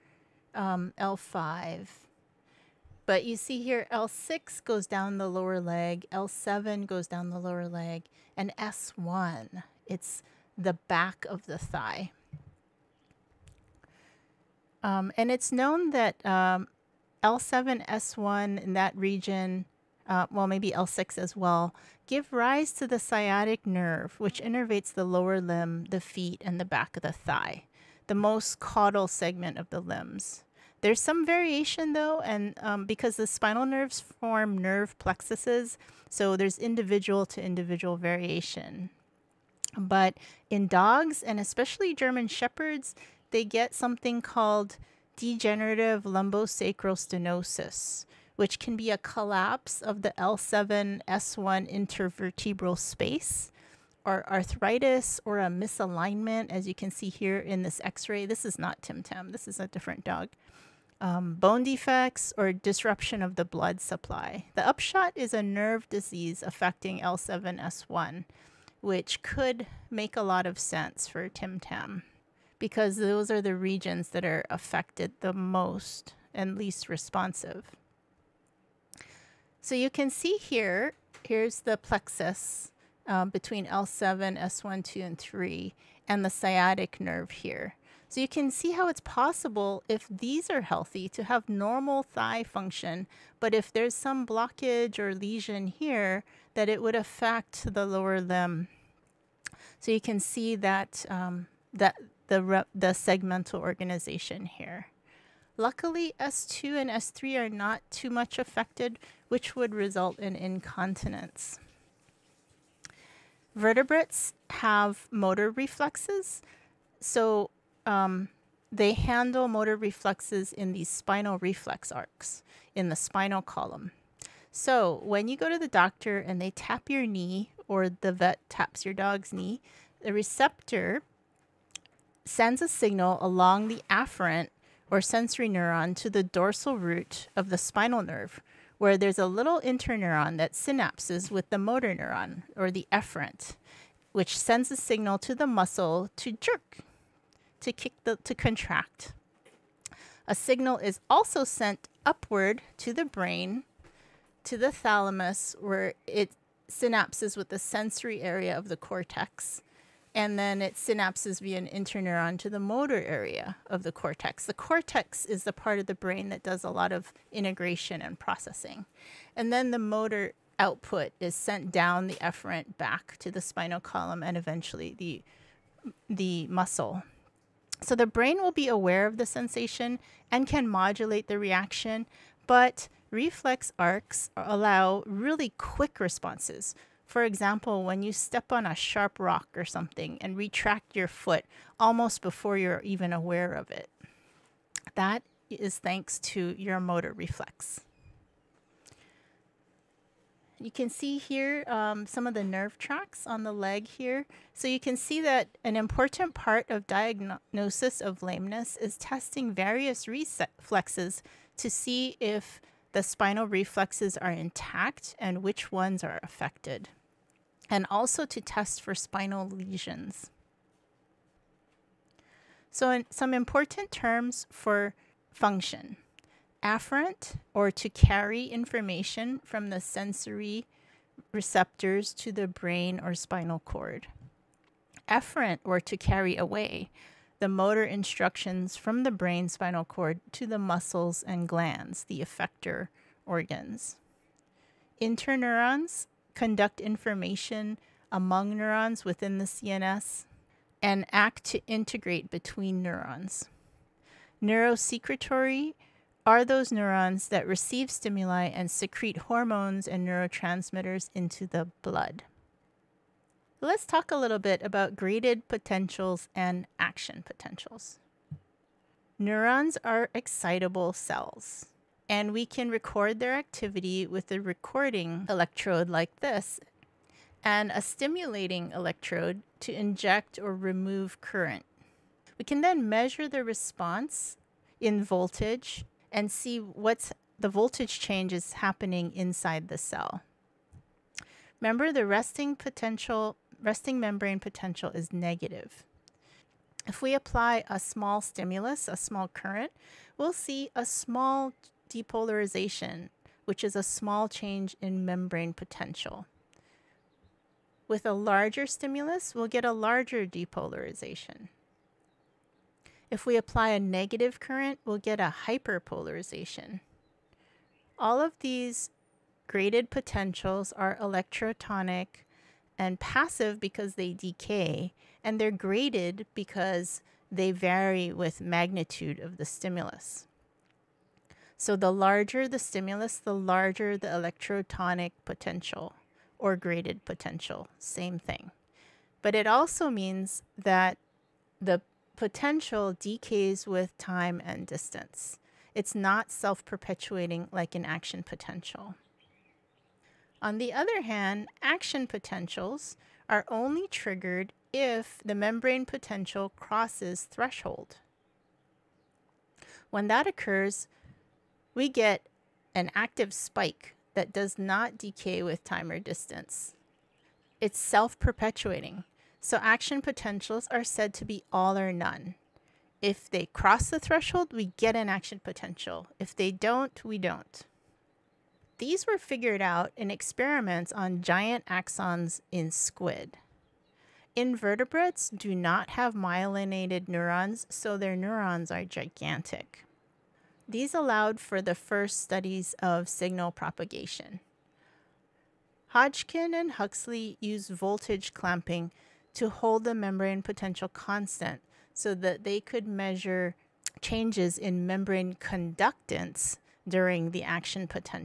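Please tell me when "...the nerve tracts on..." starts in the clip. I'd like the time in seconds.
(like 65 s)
202 s.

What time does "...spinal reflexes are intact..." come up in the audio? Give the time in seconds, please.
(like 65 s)
213 s.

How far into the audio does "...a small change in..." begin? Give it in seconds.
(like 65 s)
303 s.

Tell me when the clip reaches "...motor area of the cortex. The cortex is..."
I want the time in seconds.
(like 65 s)
162 s.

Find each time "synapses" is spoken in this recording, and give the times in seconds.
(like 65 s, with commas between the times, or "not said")
140 s, 156 s, 160 s.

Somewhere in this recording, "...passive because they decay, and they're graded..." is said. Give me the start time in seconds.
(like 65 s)
322 s.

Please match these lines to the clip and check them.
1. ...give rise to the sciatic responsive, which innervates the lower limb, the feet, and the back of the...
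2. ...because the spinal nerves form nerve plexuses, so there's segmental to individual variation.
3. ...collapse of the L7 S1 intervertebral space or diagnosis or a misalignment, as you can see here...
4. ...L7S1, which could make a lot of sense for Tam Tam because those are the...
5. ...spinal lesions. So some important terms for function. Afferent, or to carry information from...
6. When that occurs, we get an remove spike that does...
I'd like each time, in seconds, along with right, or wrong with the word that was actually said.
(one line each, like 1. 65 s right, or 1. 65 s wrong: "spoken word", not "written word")
1. 22 s wrong: "nerve", not "responsive"
2. 32 s wrong: "individual", not "segmental"
3. 48 s wrong: "arthritis", not "diagnosis"
4. 66 s wrong: "Tim", not "Tam"
5. 218 s right
6. 359 s wrong: "active", not "remove".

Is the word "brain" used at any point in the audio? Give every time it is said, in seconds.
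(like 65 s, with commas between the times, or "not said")
153 s, 165 s, 178 s, 232 s, 239 s.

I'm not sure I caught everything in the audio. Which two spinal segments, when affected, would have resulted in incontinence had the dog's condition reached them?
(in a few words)
S2 and S3.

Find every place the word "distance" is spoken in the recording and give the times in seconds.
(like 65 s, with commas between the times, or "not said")
344 s, 365 s.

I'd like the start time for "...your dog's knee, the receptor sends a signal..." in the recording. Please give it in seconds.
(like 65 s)
128 s.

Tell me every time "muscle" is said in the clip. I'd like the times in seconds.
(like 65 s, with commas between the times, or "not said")
145 s, 176 s, 240 s.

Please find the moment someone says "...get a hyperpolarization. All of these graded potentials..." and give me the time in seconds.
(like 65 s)
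314 s.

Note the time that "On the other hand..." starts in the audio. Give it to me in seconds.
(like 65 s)
350 s.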